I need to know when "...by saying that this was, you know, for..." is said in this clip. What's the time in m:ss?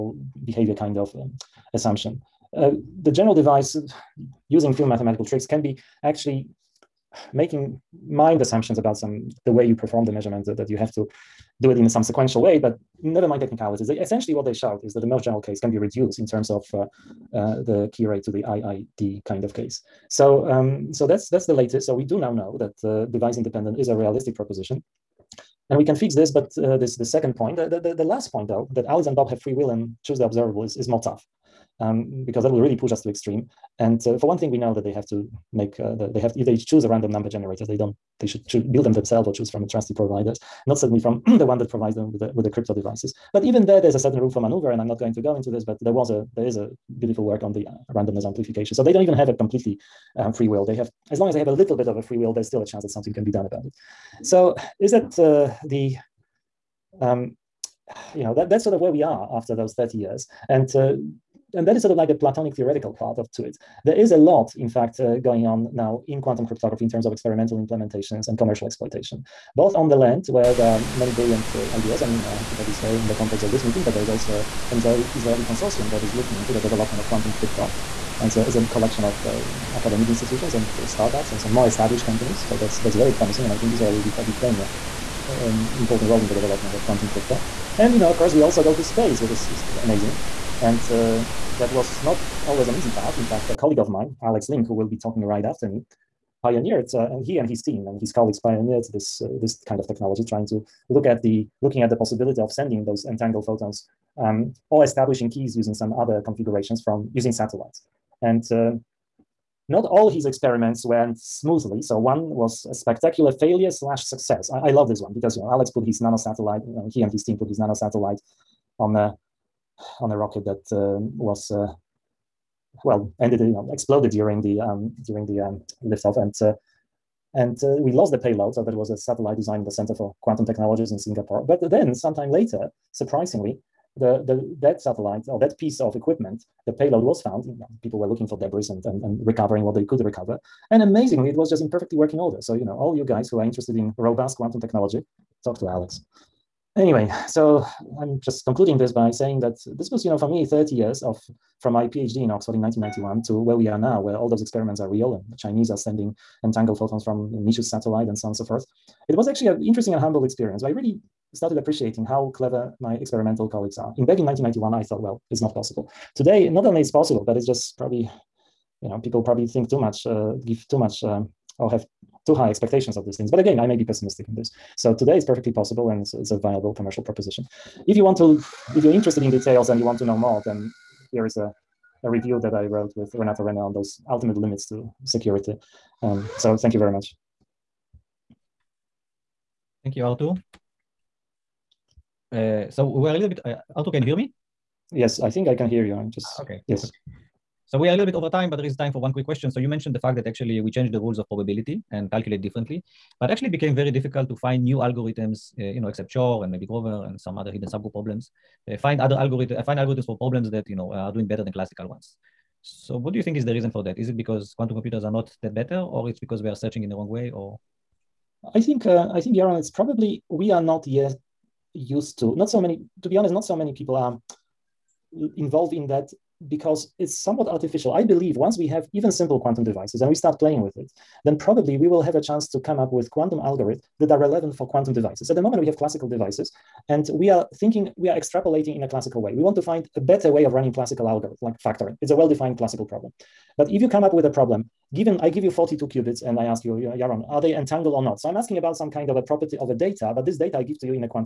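2:28.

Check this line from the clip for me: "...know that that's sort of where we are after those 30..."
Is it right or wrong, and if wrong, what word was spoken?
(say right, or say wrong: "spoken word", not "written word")
right.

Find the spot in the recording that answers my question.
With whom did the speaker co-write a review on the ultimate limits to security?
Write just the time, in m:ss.
3:03.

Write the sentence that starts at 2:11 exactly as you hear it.
But then, sometime later, surprisingly, the, the that satellite or that piece of equipment, the payload was found.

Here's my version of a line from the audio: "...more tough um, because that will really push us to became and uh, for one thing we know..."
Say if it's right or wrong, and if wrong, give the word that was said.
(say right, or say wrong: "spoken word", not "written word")
wrong: "extreme", not "became".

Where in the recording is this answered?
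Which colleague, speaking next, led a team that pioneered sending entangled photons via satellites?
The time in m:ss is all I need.
1:34.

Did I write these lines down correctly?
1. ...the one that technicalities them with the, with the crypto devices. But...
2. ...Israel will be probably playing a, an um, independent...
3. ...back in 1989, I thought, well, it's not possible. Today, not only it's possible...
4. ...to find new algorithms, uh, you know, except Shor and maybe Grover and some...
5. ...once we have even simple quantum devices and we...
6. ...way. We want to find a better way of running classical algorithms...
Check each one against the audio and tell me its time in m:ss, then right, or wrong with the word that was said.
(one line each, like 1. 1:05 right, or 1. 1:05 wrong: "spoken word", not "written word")
1. 0:41 wrong: "provides", not "technicalities"
2. 1:23 wrong: "important", not "independent"
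3. 2:44 wrong: "1991", not "1989"
4. 3:24 right
5. 3:48 right
6. 3:59 right.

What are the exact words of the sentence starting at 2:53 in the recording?
But again, I may be pessimistic in this.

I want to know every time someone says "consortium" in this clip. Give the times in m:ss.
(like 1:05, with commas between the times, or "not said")
1:15.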